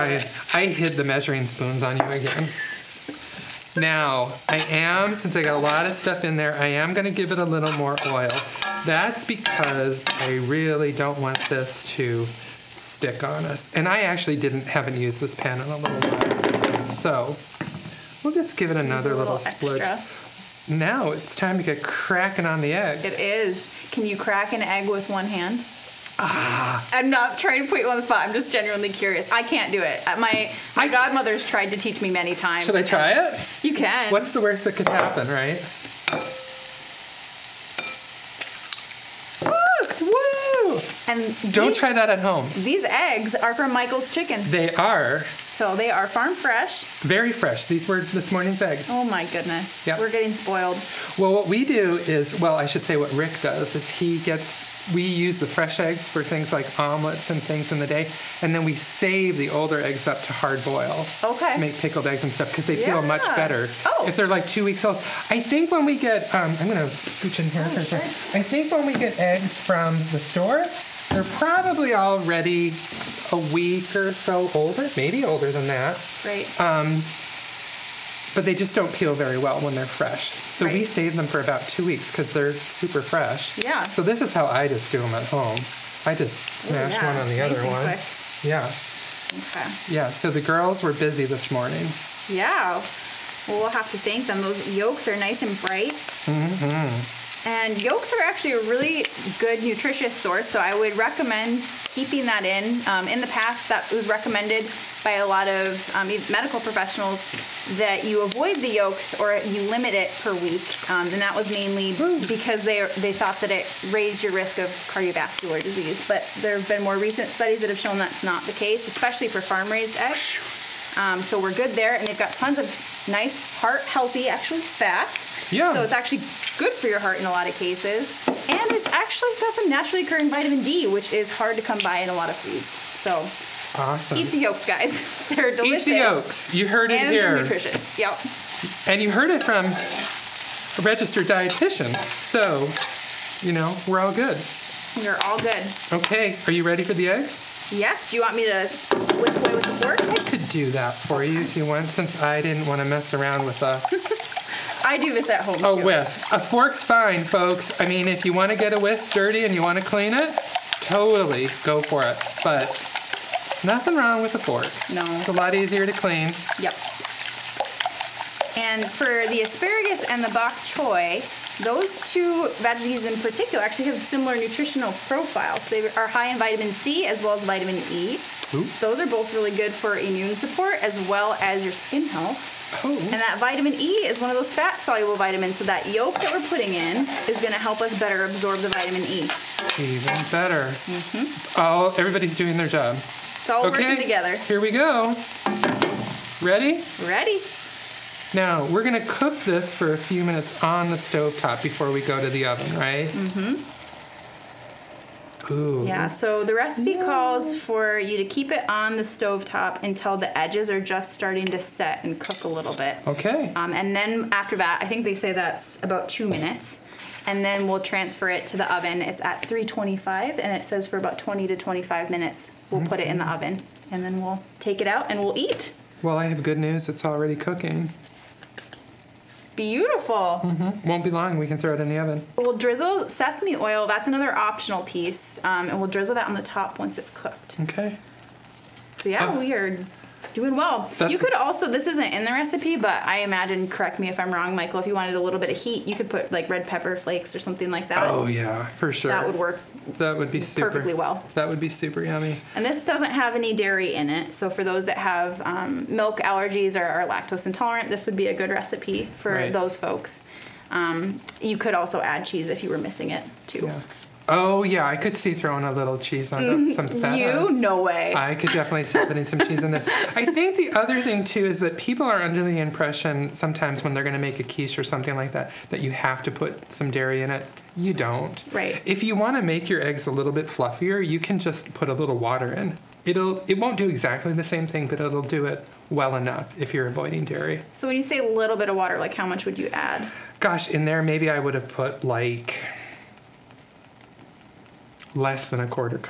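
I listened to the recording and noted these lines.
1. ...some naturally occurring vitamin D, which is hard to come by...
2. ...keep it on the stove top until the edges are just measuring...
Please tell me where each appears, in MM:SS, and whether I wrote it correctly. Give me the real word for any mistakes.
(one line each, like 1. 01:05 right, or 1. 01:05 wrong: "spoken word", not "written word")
1. 02:09 right
2. 03:28 wrong: "starting", not "measuring".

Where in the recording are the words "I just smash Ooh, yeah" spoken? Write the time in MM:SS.
01:26.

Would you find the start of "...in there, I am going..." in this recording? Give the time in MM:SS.
00:06.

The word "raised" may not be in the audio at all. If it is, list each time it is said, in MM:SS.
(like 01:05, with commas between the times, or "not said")
01:53, 01:59.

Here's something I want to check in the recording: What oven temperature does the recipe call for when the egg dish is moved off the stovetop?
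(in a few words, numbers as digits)
325.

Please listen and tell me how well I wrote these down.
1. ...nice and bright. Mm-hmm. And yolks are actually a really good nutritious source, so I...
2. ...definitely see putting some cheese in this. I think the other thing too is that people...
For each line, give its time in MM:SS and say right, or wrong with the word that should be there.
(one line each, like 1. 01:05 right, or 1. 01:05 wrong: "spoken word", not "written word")
1. 01:35 right
2. 04:28 right.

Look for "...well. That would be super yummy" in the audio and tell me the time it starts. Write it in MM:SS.
04:10.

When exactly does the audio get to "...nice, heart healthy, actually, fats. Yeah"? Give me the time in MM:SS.
02:03.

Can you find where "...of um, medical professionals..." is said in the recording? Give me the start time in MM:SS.
01:45.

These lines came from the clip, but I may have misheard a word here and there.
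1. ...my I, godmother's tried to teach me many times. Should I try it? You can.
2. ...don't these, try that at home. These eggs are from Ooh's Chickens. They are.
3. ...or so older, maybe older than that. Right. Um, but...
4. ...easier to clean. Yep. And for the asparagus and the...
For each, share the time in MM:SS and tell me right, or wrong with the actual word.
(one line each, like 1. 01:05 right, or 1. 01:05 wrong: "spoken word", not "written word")
1. 00:30 right
2. 00:41 wrong: "Michael", not "Ooh"
3. 01:13 right
4. 02:45 right.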